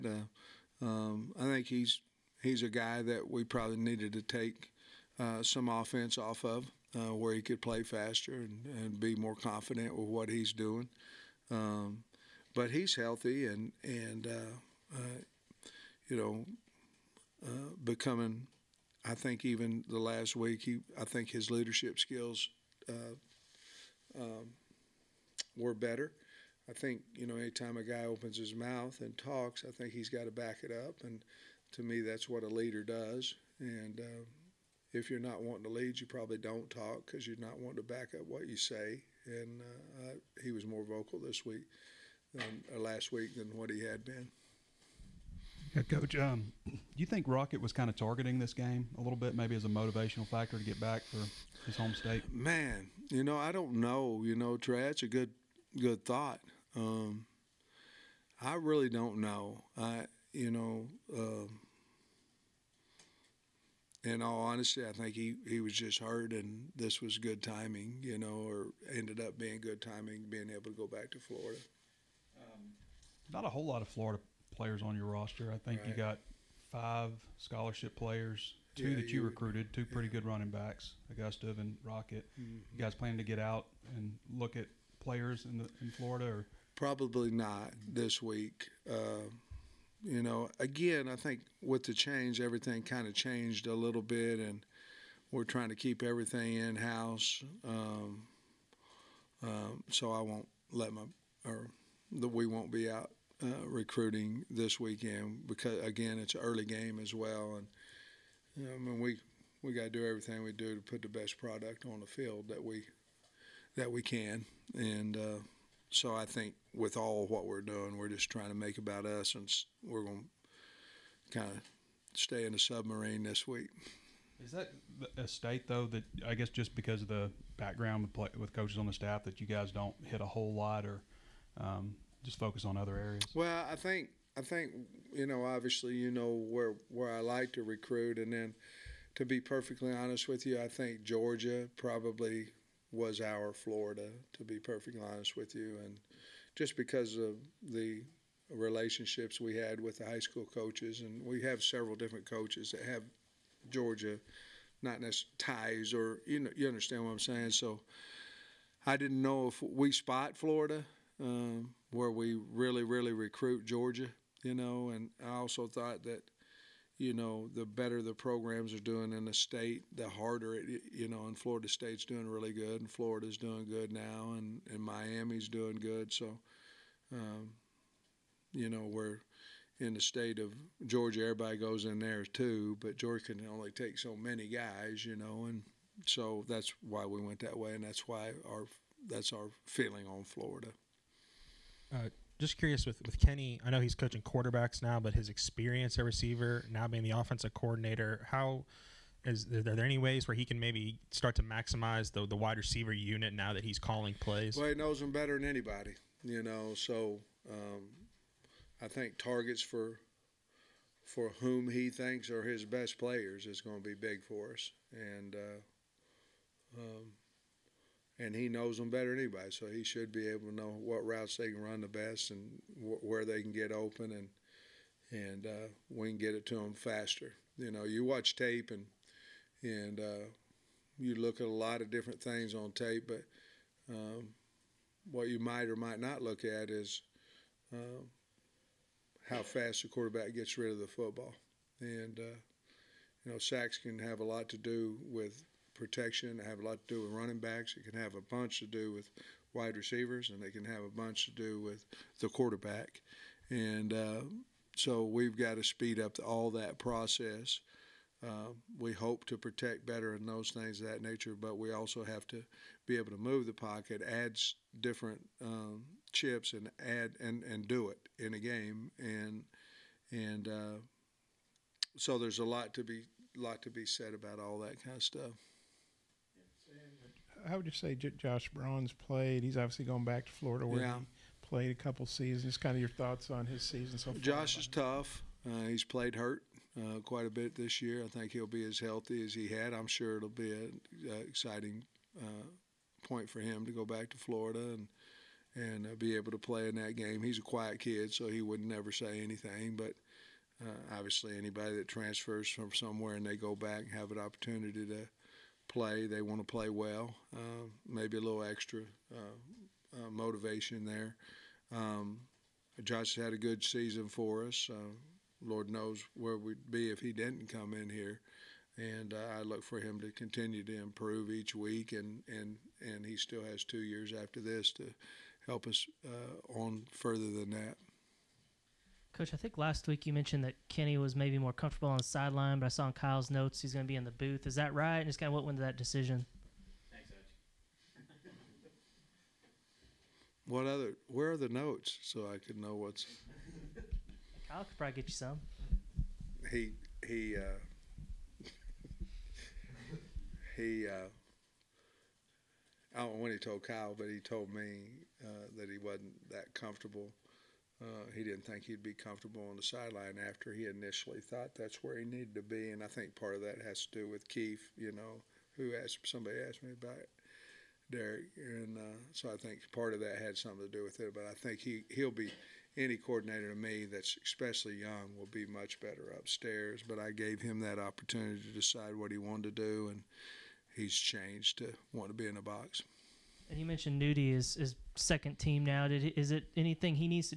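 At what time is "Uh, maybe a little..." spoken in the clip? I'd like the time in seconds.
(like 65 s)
307 s.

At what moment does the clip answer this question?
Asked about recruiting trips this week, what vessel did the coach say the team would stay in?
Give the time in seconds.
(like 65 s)
122 s.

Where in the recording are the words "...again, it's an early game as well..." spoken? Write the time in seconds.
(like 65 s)
105 s.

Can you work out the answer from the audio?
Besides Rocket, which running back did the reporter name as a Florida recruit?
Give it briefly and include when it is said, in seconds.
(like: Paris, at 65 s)
Augustave, at 81 s.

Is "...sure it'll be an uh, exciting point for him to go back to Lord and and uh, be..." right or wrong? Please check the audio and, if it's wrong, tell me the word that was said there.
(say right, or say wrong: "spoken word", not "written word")
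wrong: "Florida", not "Lord".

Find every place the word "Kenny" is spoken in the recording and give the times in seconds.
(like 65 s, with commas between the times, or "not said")
193 s, 330 s.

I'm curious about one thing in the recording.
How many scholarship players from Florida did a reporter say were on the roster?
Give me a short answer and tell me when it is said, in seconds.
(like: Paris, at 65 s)
5, at 76 s.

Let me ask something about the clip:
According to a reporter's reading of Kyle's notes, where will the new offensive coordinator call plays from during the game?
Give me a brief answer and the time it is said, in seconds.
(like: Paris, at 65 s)
the booth, at 334 s.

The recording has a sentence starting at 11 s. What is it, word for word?
Um, but he's healthy and and uh, uh you know uh, becoming.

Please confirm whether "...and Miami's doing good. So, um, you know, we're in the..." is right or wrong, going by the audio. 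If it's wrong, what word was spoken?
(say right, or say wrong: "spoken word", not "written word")
right.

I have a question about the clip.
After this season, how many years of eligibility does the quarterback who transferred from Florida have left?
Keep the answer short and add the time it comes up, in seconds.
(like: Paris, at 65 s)
2, at 323 s.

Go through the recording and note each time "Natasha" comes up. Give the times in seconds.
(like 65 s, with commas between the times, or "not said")
not said.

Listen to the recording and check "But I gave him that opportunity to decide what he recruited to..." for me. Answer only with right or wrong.
wrong.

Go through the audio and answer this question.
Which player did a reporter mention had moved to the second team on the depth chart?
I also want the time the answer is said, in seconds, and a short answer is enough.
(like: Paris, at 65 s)
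Nudie, at 384 s.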